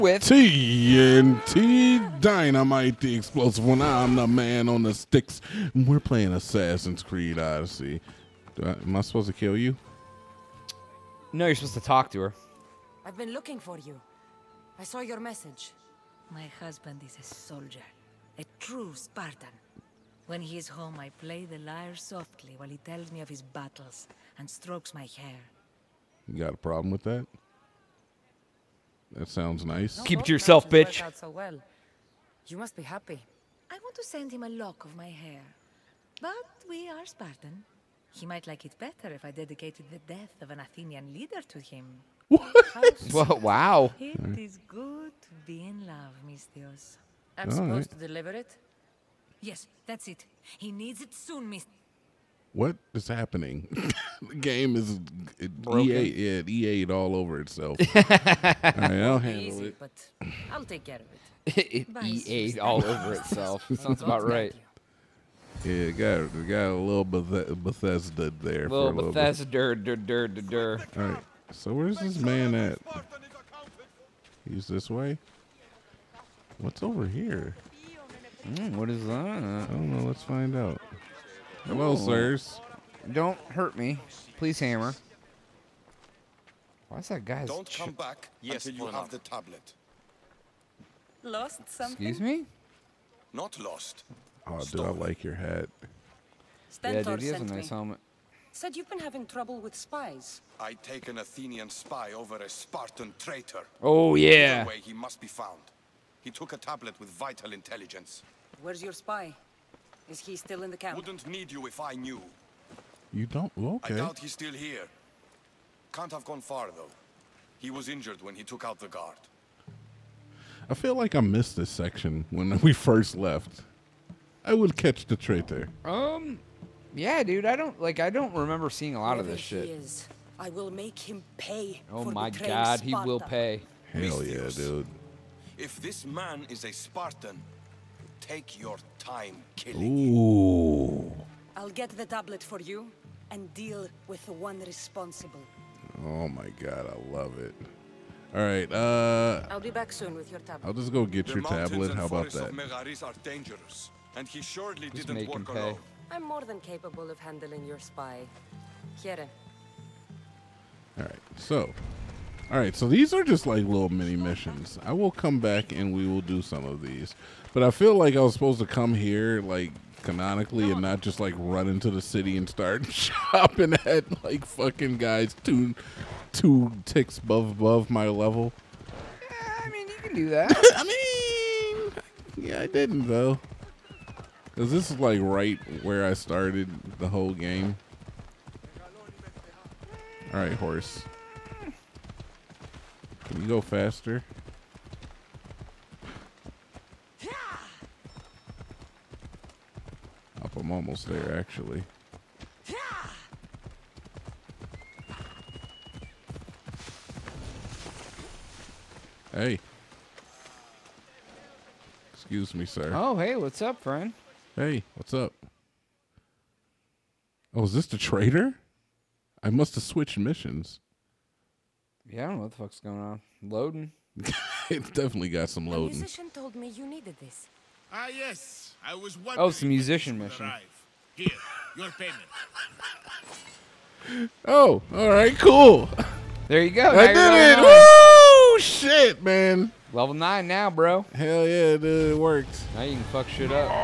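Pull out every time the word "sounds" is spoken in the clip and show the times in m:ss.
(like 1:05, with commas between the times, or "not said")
0:29, 1:03.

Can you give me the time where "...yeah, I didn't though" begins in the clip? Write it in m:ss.
3:02.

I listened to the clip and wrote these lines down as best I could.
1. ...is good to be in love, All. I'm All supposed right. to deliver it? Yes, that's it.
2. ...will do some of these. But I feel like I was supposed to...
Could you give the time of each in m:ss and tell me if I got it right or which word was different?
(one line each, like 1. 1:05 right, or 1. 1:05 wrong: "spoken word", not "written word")
1. 0:44 wrong: "Misthios", not "All"
2. 2:46 right.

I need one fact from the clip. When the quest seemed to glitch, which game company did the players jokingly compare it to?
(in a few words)
EA.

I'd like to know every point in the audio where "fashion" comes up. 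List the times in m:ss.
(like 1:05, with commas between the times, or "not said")
not said.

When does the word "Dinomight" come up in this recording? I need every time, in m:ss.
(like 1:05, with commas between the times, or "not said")
0:02.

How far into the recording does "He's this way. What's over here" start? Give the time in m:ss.
1:14.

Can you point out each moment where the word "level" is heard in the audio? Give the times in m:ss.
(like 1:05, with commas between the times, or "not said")
2:58, 3:59.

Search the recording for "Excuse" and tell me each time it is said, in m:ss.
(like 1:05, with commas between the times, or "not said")
1:32, 3:32.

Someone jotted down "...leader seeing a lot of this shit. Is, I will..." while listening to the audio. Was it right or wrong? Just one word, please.
wrong.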